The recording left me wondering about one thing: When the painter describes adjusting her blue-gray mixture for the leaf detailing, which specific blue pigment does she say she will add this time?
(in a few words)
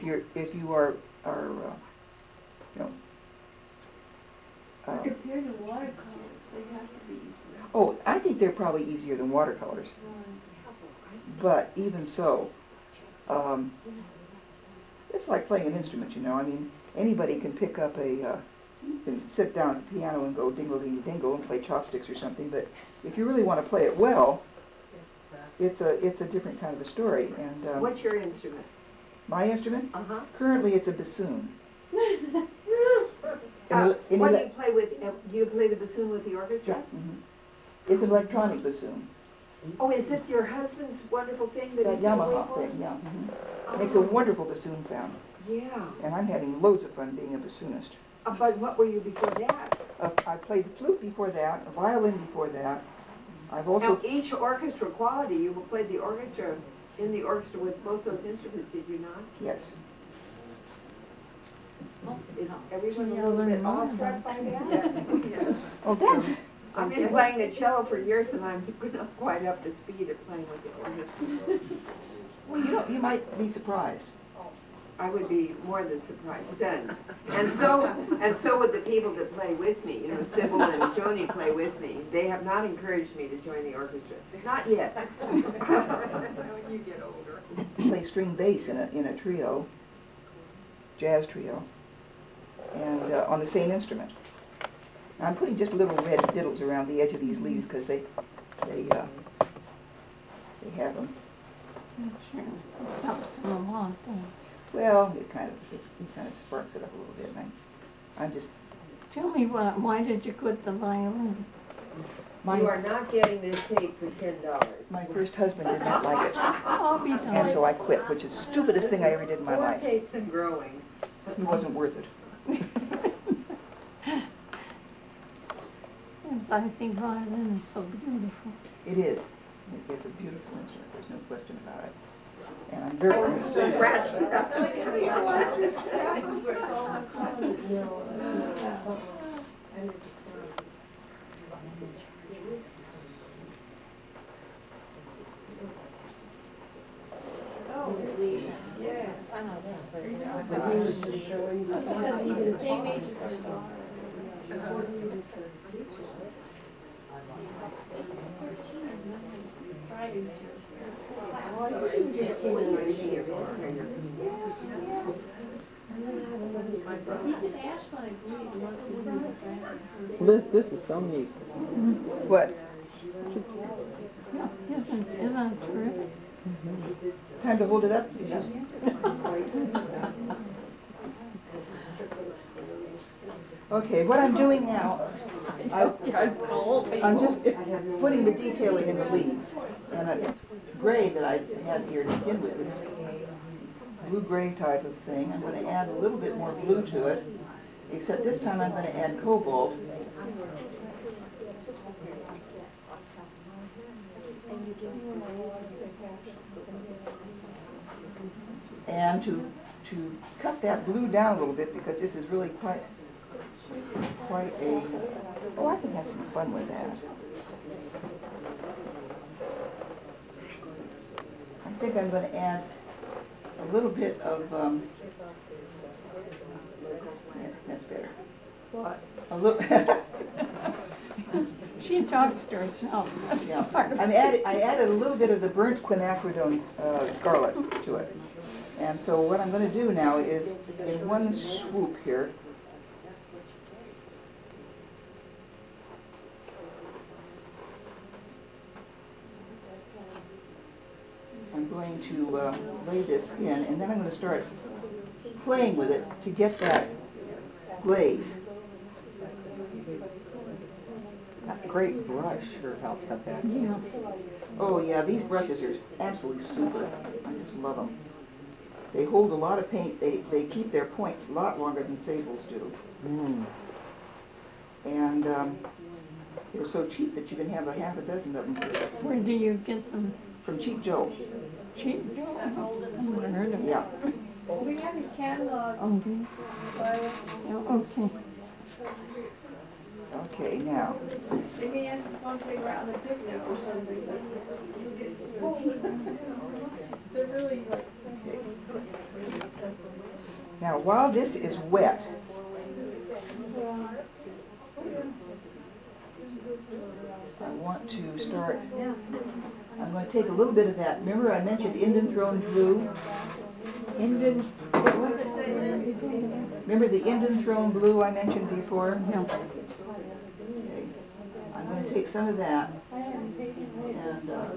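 Cobalt.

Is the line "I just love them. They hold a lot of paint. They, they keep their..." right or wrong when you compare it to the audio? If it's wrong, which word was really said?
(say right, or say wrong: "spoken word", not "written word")
right.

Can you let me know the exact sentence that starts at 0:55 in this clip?
You played the orchestra in the orchestra with both those instruments, did you not?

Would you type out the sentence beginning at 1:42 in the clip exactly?
sure, it helps them Well, it kind of it, it, kind of sparks it up a little bit.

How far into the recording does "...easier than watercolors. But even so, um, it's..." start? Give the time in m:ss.
0:08.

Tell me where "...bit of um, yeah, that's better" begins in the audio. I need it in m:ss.
3:43.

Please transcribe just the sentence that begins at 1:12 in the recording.
Well, you know, you might be surprised.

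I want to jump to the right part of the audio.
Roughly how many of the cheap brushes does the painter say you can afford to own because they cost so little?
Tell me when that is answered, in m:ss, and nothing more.
4:37.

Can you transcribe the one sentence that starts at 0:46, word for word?
And I'm having loads of fun being a bassoonist.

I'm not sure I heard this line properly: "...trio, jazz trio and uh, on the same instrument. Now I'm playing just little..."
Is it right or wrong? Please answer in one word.
wrong.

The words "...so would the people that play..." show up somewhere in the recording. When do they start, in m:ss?
1:18.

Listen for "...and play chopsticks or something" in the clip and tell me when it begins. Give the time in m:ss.
0:21.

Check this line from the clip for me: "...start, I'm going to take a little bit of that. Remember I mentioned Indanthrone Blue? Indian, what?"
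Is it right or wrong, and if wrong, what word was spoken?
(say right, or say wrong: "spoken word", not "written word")
right.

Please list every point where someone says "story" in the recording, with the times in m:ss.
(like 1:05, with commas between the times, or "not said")
0:26.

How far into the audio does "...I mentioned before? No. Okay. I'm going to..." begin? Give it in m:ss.
5:18.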